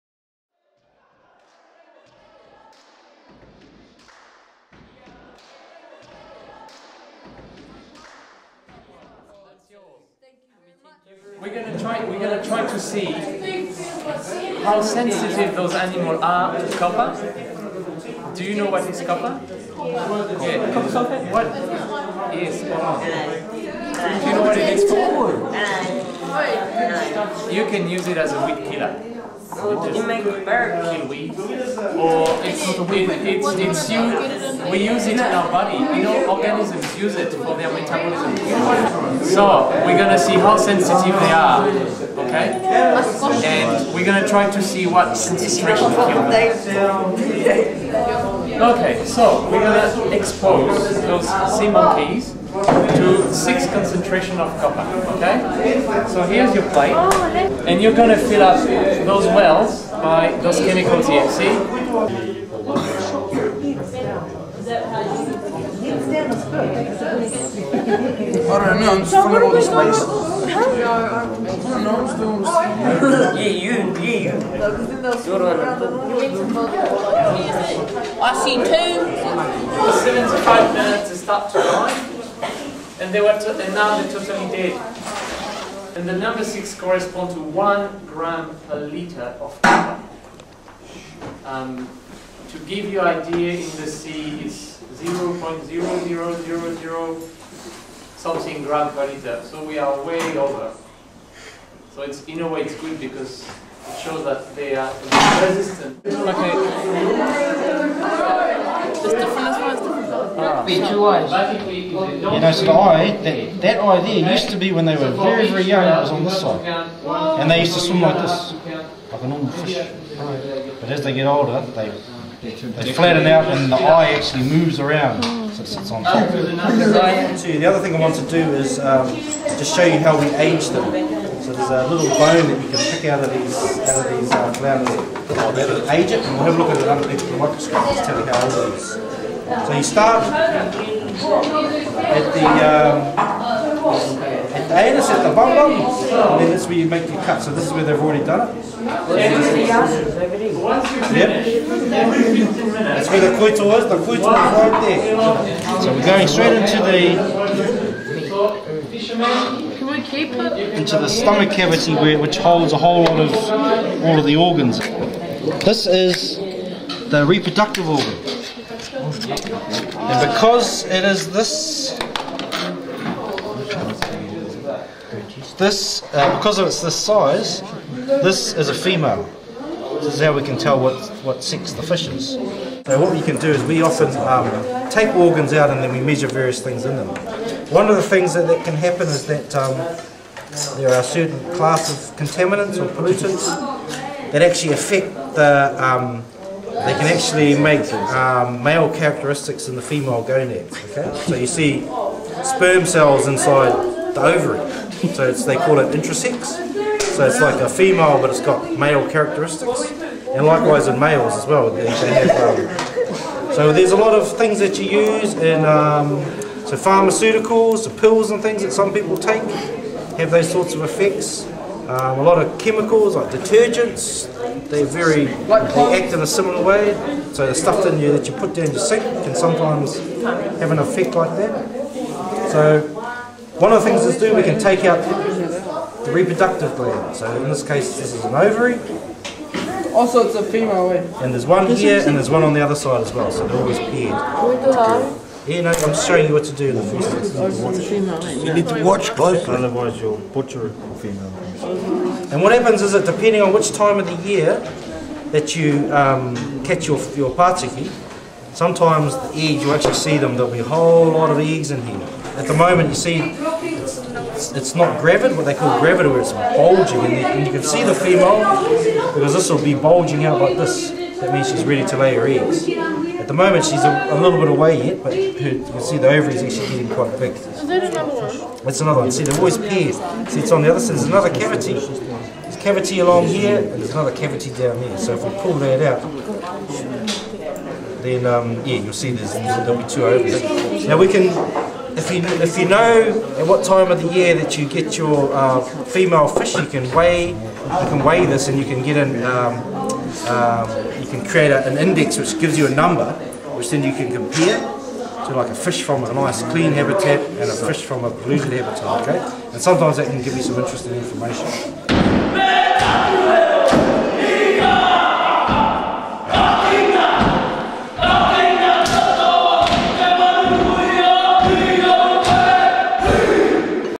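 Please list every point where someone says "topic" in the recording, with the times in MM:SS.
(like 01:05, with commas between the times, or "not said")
not said.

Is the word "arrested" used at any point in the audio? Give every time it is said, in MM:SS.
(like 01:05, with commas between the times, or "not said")
not said.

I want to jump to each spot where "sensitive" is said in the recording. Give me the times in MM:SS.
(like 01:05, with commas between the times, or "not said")
00:14, 00:40.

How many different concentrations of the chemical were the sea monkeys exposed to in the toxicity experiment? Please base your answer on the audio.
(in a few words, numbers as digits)
6.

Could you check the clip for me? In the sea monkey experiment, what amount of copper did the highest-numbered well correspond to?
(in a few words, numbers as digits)
1 gram per liter.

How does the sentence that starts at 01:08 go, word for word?
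I don't know, I'm just filling all oh, Yeah, you, yeah, you.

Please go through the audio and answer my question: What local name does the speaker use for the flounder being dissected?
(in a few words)
patiki.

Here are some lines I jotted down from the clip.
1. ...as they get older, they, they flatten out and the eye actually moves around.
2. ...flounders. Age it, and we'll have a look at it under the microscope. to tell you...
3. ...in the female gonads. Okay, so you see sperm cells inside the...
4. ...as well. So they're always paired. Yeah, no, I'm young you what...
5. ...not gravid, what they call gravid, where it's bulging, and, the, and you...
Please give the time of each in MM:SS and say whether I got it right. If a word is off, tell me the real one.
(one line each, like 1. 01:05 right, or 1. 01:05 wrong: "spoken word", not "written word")
1. 02:00 right
2. 02:14 right
3. 03:19 right
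4. 04:03 wrong: "showing", not "young"
5. 04:24 right.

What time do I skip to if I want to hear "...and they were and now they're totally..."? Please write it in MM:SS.
01:23.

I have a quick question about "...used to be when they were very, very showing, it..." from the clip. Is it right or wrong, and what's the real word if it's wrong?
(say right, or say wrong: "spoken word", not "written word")
wrong: "young", not "showing".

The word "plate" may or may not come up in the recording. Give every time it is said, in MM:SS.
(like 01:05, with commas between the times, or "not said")
00:56.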